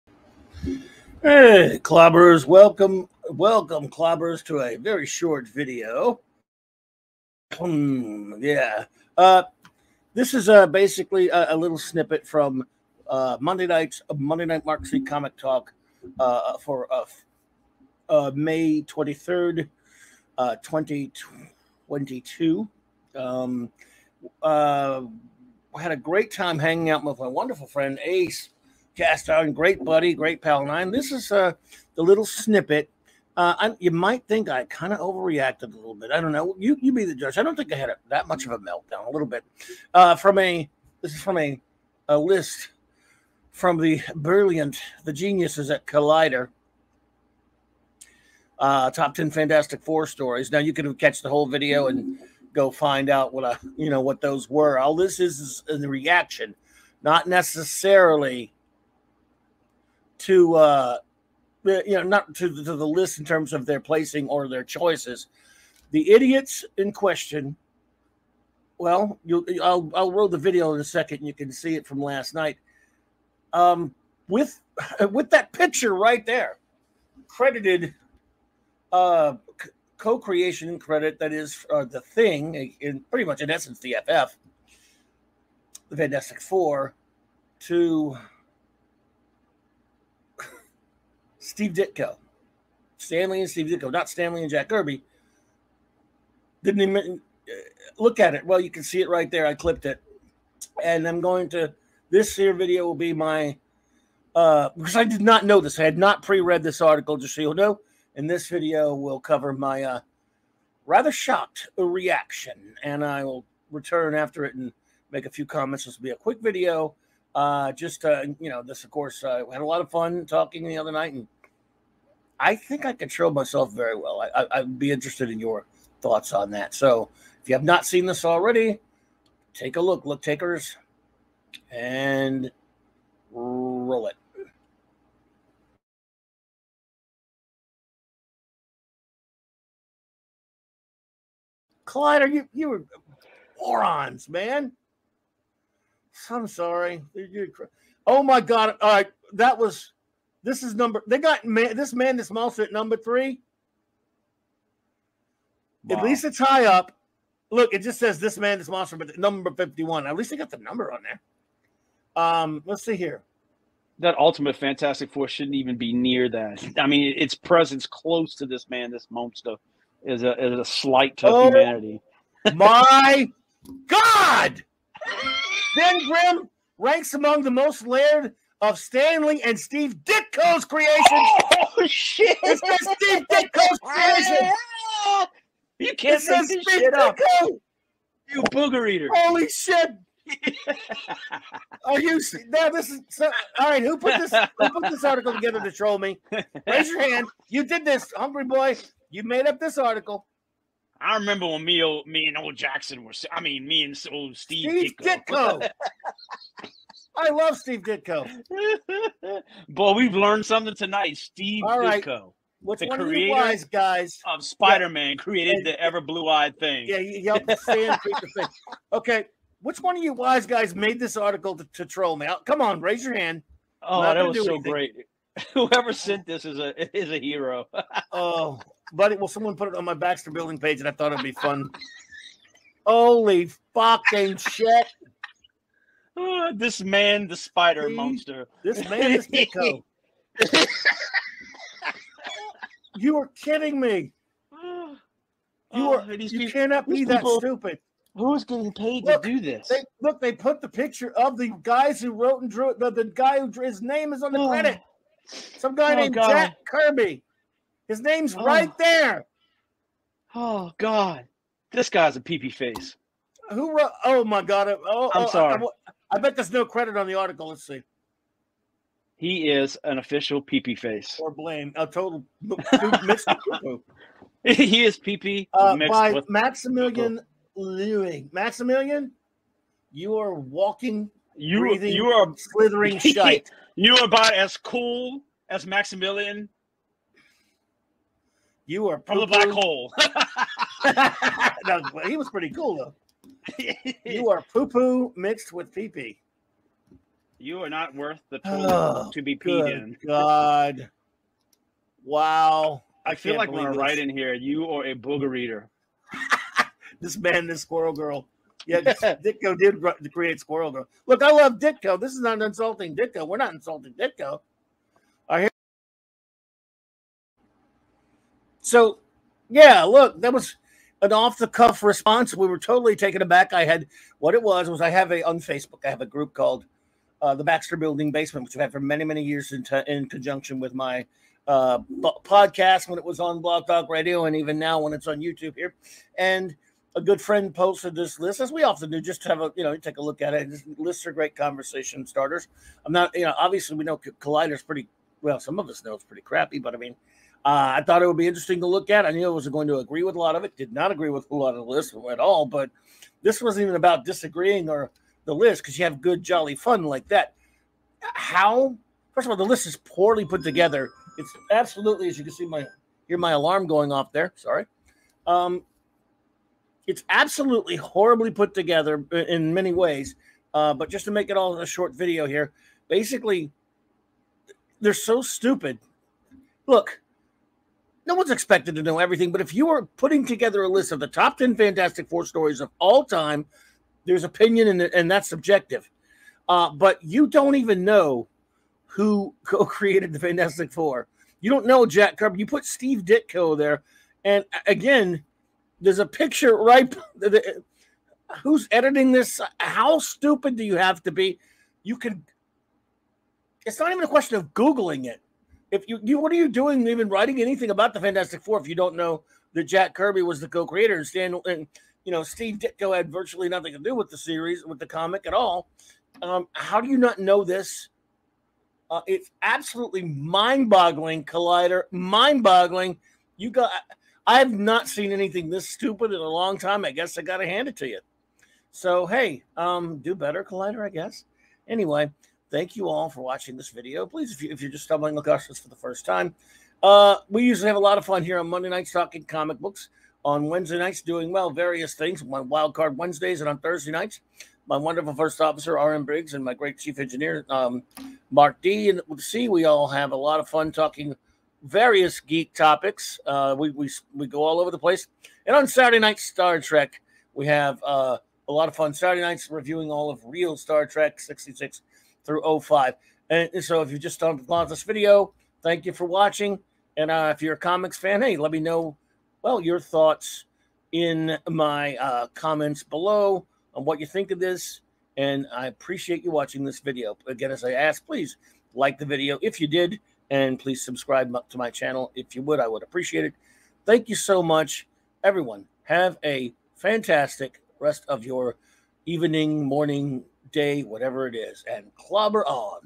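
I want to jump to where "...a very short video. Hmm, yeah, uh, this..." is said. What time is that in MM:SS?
00:04.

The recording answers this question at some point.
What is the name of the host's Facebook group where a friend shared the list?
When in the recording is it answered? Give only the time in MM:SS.
05:27.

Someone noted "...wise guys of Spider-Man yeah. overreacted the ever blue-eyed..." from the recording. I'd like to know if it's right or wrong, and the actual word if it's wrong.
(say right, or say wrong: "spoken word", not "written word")
wrong: "created", not "overreacted".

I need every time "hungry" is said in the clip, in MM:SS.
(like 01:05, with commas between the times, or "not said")
03:18.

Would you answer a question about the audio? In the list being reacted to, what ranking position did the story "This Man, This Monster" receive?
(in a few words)
3.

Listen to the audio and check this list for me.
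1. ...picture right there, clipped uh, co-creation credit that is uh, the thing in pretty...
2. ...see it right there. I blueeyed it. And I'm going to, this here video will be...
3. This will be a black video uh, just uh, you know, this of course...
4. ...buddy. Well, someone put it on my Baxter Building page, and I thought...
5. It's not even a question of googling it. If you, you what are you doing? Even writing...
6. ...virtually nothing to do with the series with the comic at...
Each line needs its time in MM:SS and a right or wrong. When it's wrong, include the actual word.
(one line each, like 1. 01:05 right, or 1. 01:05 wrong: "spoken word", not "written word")
1. 01:15 wrong: "credited", not "clipped"
2. 01:38 wrong: "clipped", not "blueeyed"
3. 01:55 wrong: "quick", not "black"
4. 03:48 right
5. 06:43 right
6. 06:53 right.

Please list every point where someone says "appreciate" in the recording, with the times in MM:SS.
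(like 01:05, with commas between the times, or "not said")
07:55, 08:02.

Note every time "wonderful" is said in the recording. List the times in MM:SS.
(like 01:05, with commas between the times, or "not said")
00:27, 07:24.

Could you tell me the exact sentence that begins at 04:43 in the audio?
you are about as cool as Maximilian.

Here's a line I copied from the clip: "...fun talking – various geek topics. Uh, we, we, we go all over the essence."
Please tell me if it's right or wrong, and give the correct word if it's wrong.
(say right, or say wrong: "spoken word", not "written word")
wrong: "place", not "essence".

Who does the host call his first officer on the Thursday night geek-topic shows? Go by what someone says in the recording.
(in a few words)
R.M. Briggs.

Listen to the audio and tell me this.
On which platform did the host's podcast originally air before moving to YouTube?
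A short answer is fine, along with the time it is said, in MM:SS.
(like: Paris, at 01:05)
Blog Talk Radio, at 05:33.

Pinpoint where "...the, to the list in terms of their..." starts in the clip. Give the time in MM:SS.
01:02.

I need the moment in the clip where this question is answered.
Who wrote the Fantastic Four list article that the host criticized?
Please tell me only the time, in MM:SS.
04:36.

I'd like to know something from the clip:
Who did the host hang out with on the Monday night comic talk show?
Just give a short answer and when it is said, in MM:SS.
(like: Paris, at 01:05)
Ace Castiron, at 00:28.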